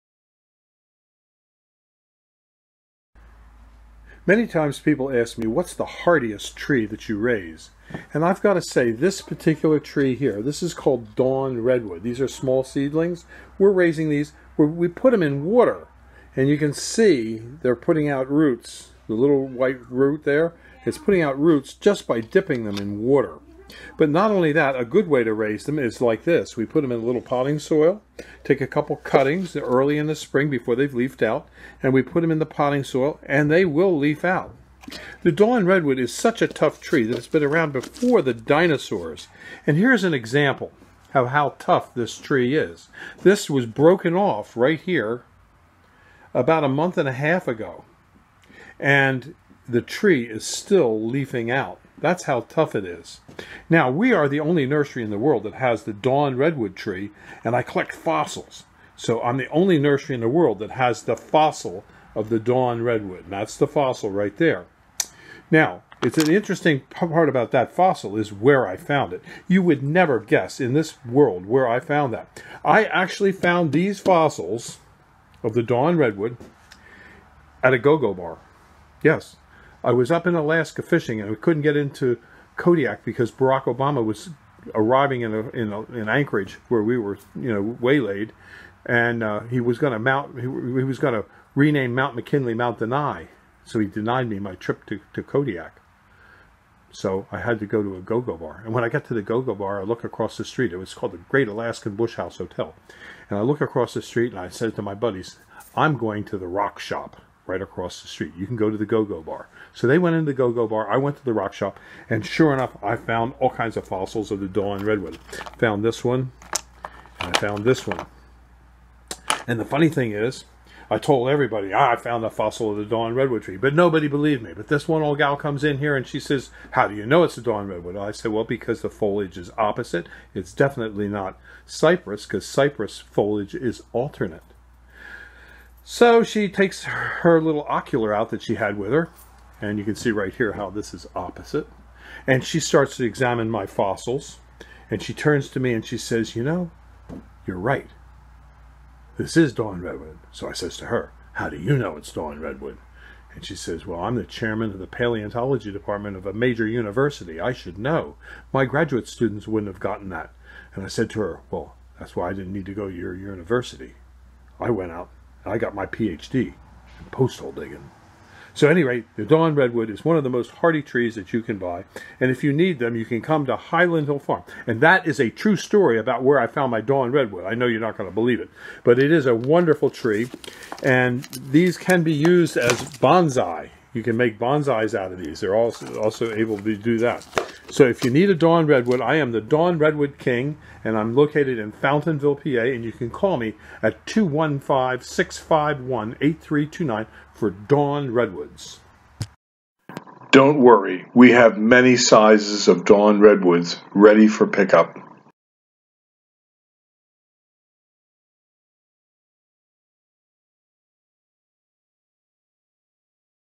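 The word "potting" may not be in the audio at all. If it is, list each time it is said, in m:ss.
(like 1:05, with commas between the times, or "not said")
0:27, 0:32.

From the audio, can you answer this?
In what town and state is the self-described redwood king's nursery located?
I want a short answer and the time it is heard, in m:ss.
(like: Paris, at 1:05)
Fountainville, PA, at 3:11.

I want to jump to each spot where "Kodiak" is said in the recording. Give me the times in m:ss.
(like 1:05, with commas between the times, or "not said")
1:22, 1:35.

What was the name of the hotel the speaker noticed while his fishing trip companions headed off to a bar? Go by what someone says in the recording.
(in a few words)
Great Alaskan Bush House Hotel.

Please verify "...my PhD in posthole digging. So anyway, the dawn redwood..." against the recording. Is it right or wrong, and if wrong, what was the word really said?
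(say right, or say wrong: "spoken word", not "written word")
right.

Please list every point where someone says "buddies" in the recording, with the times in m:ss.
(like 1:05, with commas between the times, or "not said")
1:44.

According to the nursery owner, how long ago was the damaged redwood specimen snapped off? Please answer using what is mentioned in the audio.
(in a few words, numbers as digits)
a month and a half.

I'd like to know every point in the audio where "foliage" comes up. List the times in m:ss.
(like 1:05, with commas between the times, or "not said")
2:08, 2:12.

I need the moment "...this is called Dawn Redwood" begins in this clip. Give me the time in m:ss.
0:10.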